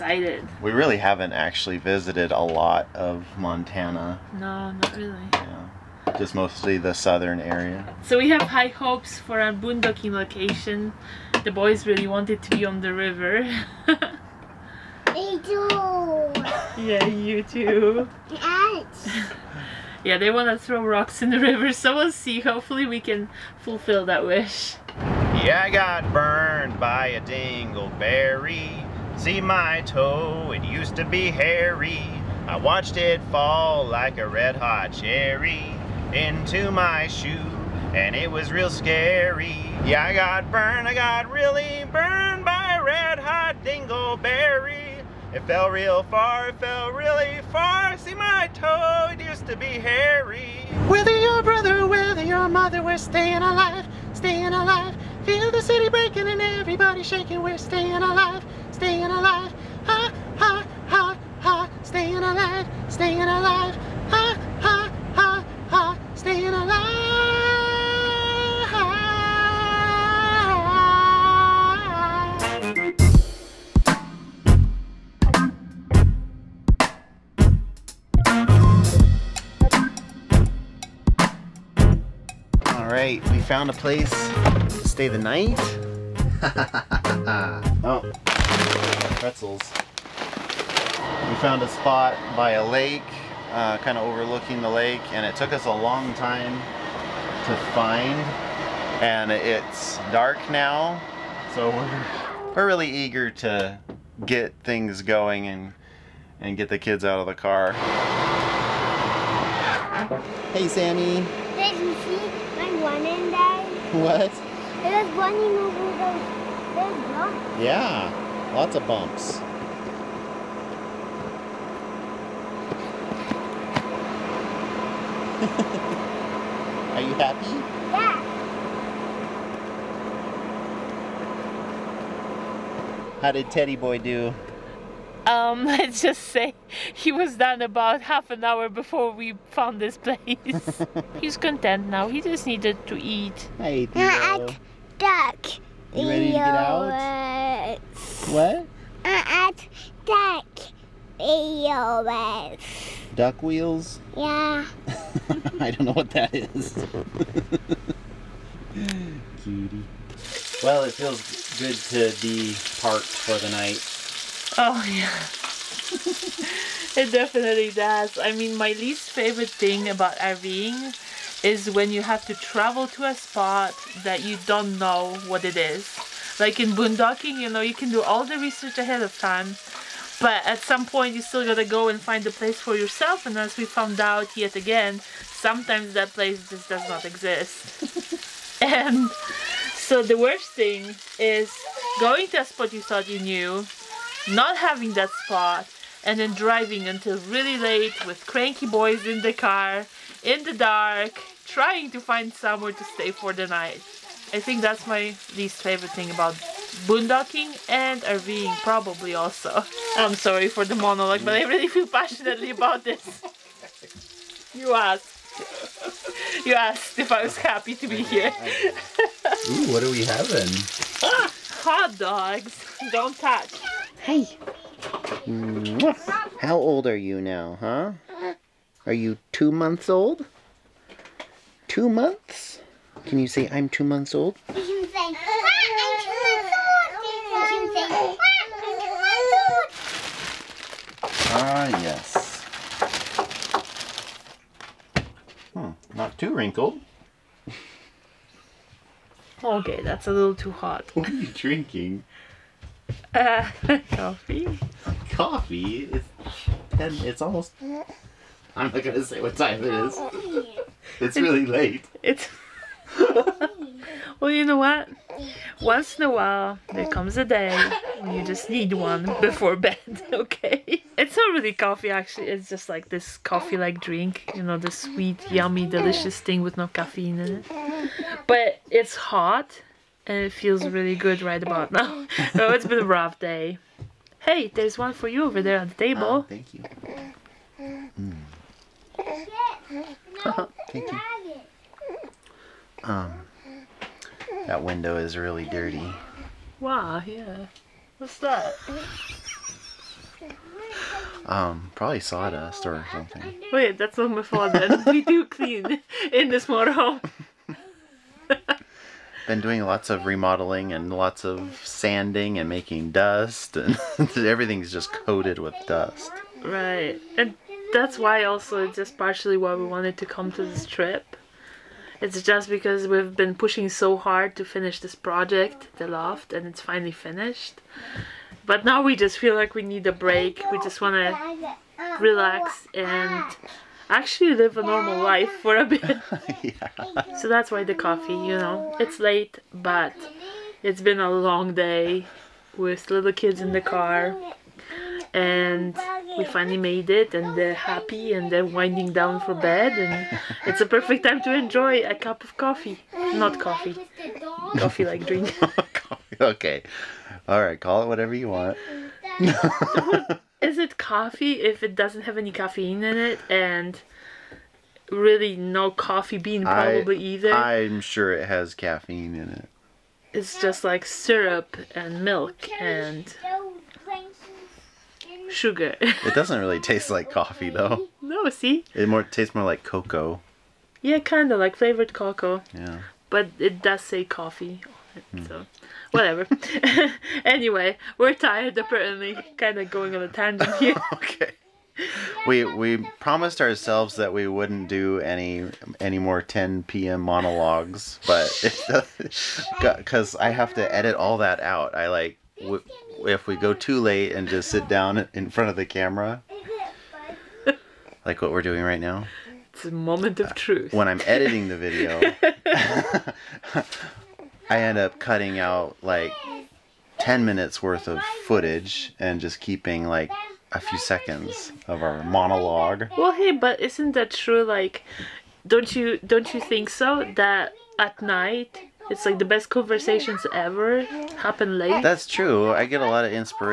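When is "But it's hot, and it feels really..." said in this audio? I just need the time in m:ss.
4:38.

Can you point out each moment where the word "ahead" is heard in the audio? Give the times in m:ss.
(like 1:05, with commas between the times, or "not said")
2:58.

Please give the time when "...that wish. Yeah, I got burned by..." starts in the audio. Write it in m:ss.
0:24.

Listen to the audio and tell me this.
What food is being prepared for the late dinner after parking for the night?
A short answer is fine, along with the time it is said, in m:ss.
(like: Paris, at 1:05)
Hot dogs, at 3:41.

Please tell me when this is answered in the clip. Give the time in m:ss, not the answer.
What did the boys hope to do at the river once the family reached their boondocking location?
0:20.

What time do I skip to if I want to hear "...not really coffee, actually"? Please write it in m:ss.
4:31.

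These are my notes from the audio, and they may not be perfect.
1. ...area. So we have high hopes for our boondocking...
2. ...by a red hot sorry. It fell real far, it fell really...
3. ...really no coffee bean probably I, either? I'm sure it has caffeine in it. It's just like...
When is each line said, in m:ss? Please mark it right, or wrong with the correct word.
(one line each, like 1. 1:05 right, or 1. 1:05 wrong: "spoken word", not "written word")
1. 0:07 right
2. 0:42 wrong: "dingleberry", not "sorry"
3. 6:04 right.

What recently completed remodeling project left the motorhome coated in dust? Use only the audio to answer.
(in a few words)
The loft.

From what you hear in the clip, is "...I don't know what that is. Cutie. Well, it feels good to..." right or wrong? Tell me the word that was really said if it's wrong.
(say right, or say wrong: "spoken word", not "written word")
right.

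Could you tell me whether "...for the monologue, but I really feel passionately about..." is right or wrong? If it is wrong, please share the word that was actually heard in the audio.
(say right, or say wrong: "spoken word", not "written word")
right.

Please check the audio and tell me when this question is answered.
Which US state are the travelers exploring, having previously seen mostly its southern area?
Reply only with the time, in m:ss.
0:03.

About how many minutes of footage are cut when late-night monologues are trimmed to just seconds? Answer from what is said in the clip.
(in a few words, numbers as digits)
10 minutes.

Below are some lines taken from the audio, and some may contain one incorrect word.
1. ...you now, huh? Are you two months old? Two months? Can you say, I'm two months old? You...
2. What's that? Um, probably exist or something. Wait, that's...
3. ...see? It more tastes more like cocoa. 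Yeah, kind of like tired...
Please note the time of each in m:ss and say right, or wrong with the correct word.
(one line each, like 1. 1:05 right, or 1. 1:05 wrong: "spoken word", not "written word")
1. 3:46 right
2. 4:57 wrong: "sawdust", not "exist"
3. 6:18 wrong: "flavored", not "tired".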